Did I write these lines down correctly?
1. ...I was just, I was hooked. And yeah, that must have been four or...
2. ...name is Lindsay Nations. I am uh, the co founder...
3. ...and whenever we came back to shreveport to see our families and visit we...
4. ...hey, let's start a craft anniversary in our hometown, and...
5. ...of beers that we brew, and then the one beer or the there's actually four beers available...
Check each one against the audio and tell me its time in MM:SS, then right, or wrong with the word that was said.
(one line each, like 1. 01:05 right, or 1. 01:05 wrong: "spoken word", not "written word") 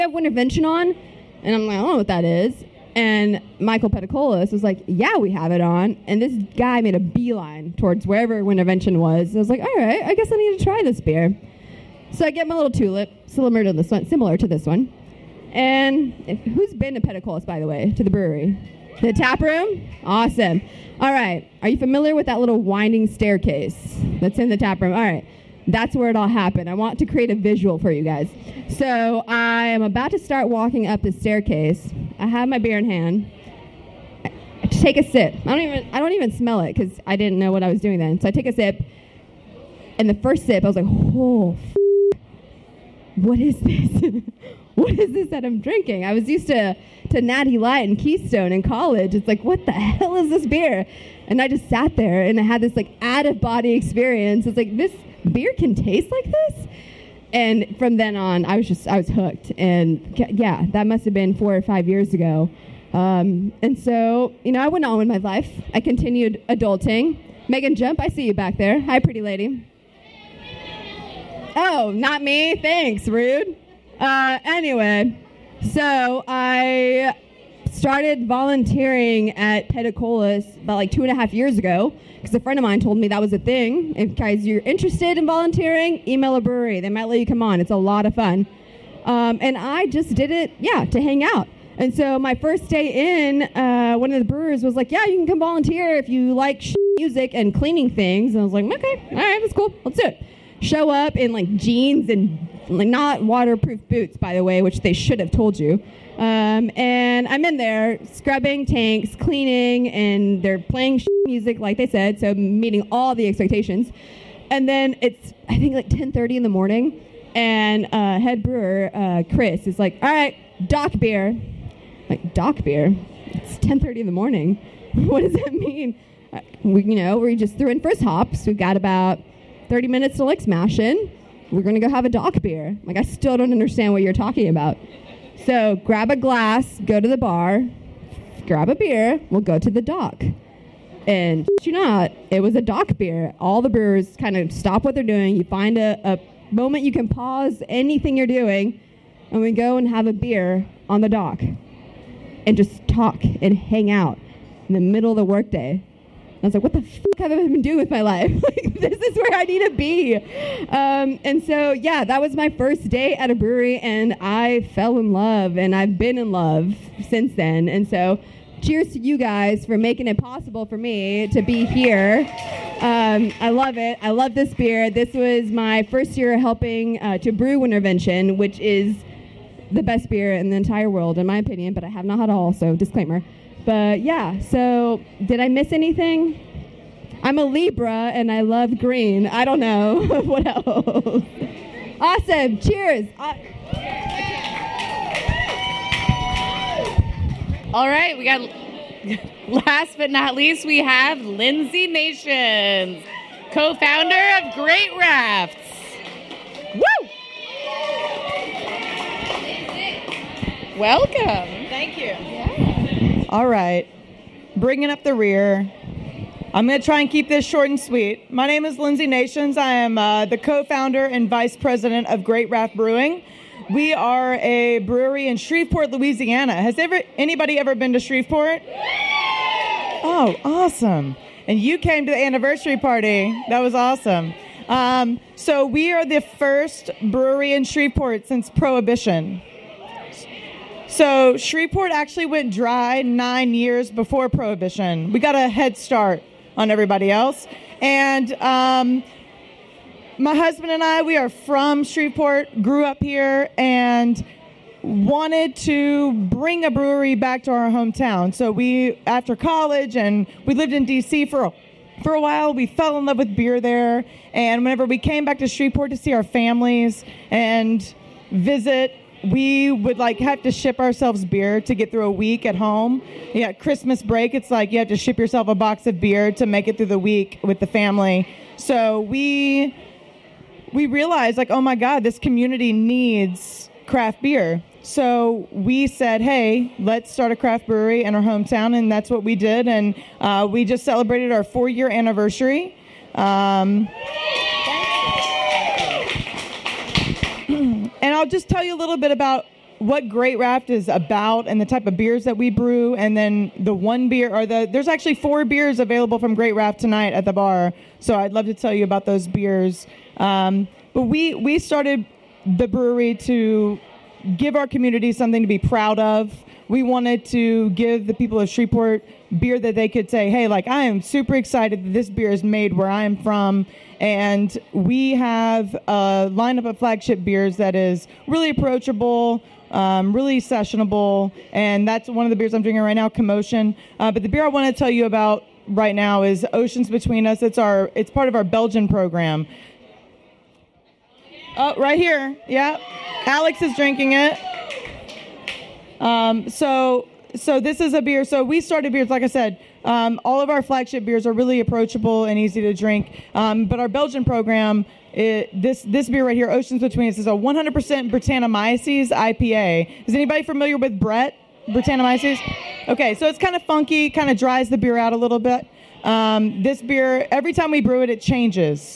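1. 00:58 right
2. 03:38 right
3. 04:24 right
4. 04:46 wrong: "brewery", not "anniversary"
5. 05:01 right.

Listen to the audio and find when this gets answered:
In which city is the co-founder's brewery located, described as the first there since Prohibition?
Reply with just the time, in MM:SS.
03:45.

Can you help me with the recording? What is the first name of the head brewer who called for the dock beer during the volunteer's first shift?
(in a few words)
Chris.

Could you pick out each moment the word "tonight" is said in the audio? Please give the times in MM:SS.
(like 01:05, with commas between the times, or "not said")
05:06.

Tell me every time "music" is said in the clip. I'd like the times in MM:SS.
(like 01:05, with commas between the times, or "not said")
01:36, 01:51.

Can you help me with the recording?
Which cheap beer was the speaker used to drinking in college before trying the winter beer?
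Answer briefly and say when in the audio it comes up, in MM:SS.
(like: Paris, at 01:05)
Natty Light, at 00:47.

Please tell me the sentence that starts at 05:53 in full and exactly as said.
Um, but our Belgian program, it, this this beer right here, Oceans Between Us, is a 100% Brettanomyces IPA.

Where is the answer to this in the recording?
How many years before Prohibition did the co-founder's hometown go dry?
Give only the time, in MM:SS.
04:03.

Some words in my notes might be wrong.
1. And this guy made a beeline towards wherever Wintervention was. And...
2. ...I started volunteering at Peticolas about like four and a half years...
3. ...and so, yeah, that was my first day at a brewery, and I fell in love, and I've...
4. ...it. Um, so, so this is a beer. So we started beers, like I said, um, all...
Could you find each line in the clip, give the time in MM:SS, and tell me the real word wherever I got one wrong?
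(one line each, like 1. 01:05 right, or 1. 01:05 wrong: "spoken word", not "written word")
1. 00:06 right
2. 01:16 wrong: "two", not "four"
3. 02:41 right
4. 05:44 right.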